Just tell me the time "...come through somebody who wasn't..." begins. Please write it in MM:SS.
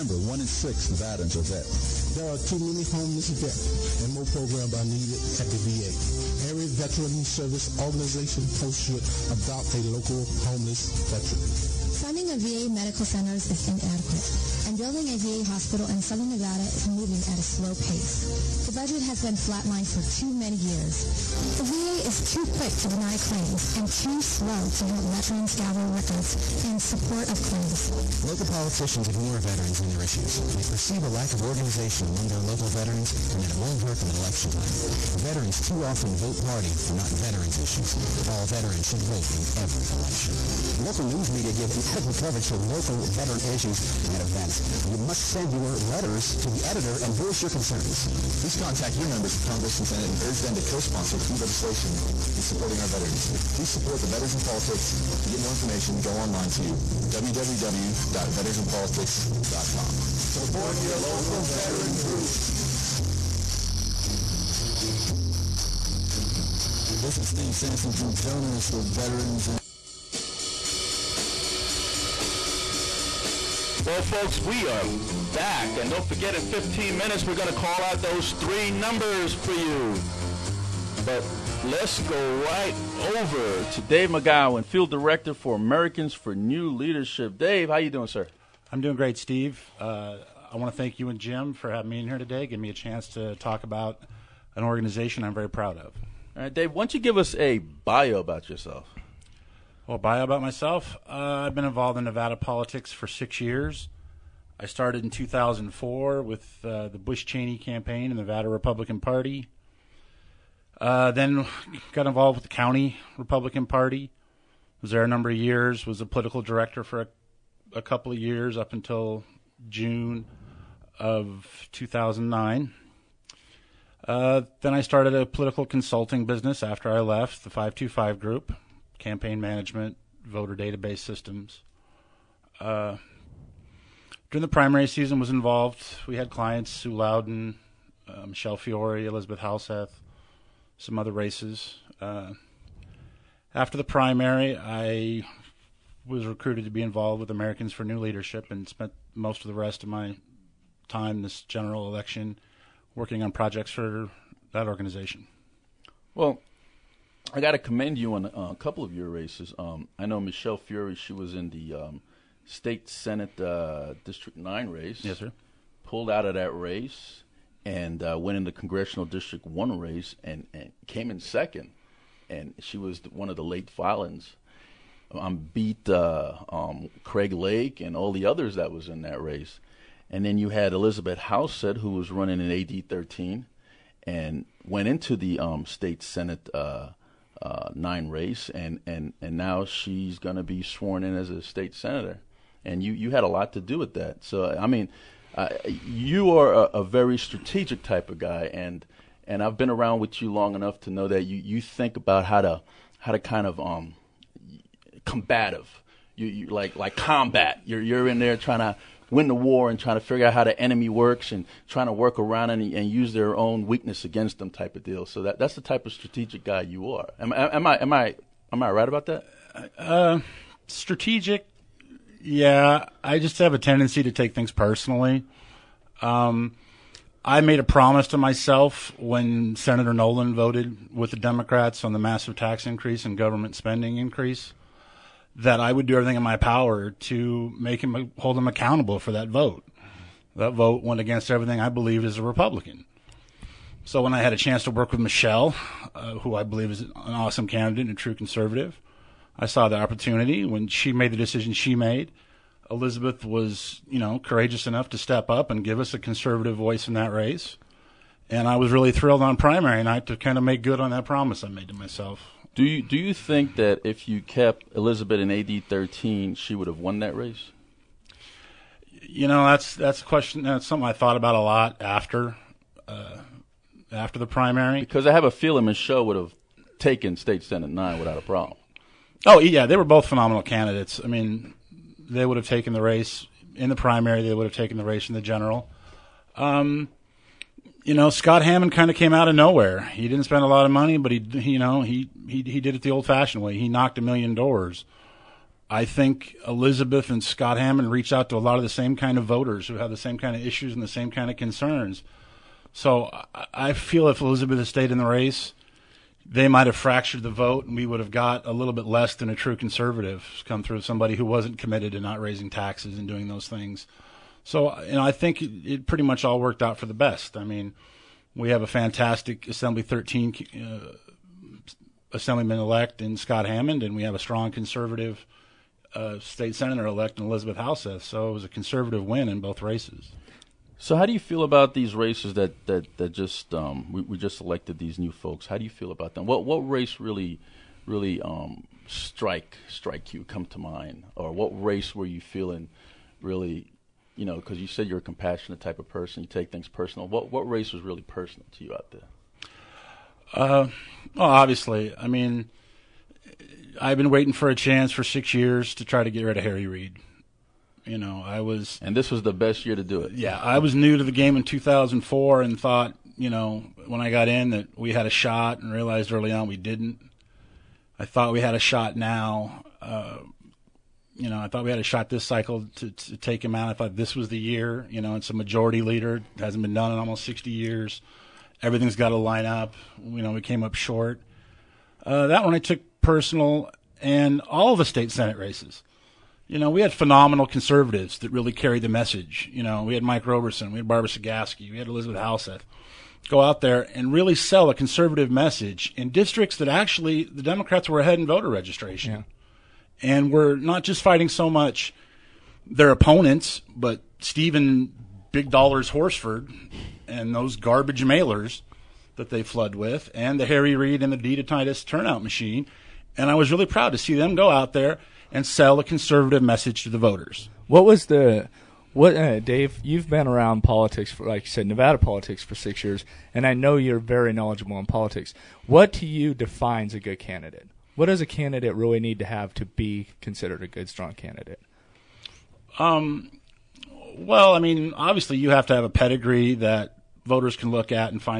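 05:10.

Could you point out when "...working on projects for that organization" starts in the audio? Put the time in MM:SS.
02:32.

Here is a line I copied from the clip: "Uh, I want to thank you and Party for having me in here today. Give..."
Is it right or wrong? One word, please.
wrong.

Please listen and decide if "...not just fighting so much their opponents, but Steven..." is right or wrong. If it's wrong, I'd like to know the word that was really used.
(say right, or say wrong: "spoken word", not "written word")
right.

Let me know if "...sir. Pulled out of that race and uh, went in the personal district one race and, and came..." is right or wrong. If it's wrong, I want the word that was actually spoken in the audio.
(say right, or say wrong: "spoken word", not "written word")
wrong: "congressional", not "personal".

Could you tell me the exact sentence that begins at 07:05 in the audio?
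What to you defines a good candidate?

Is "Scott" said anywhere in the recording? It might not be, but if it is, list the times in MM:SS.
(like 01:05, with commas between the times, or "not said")
04:48, 04:57, 05:23.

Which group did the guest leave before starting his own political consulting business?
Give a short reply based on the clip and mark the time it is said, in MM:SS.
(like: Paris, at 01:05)
the 525 group, at 02:07.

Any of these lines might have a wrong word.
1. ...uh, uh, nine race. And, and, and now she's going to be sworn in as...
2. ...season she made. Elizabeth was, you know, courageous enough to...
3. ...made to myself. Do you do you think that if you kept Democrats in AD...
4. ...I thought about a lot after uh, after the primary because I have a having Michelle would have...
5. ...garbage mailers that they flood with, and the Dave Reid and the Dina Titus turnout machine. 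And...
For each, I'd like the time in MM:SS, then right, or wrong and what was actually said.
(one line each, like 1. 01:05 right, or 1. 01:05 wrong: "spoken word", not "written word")
1. 03:06 right
2. 04:11 wrong: "decision", not "season"
3. 04:21 wrong: "Elizabeth", not "Democrats"
4. 04:30 wrong: "feeling", not "having"
5. 06:47 wrong: "Harry", not "Dave".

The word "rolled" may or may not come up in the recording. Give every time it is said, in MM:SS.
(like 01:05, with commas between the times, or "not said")
not said.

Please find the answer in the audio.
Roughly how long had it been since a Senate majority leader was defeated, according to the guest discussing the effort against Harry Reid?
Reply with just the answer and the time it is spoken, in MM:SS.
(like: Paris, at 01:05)
almost 60 years, at 06:16.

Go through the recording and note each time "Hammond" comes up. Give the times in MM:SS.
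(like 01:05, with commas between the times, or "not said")
04:48, 04:57, 05:23.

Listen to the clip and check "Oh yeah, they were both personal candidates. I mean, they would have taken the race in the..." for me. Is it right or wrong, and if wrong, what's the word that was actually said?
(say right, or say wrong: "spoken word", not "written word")
wrong: "phenomenal", not "personal".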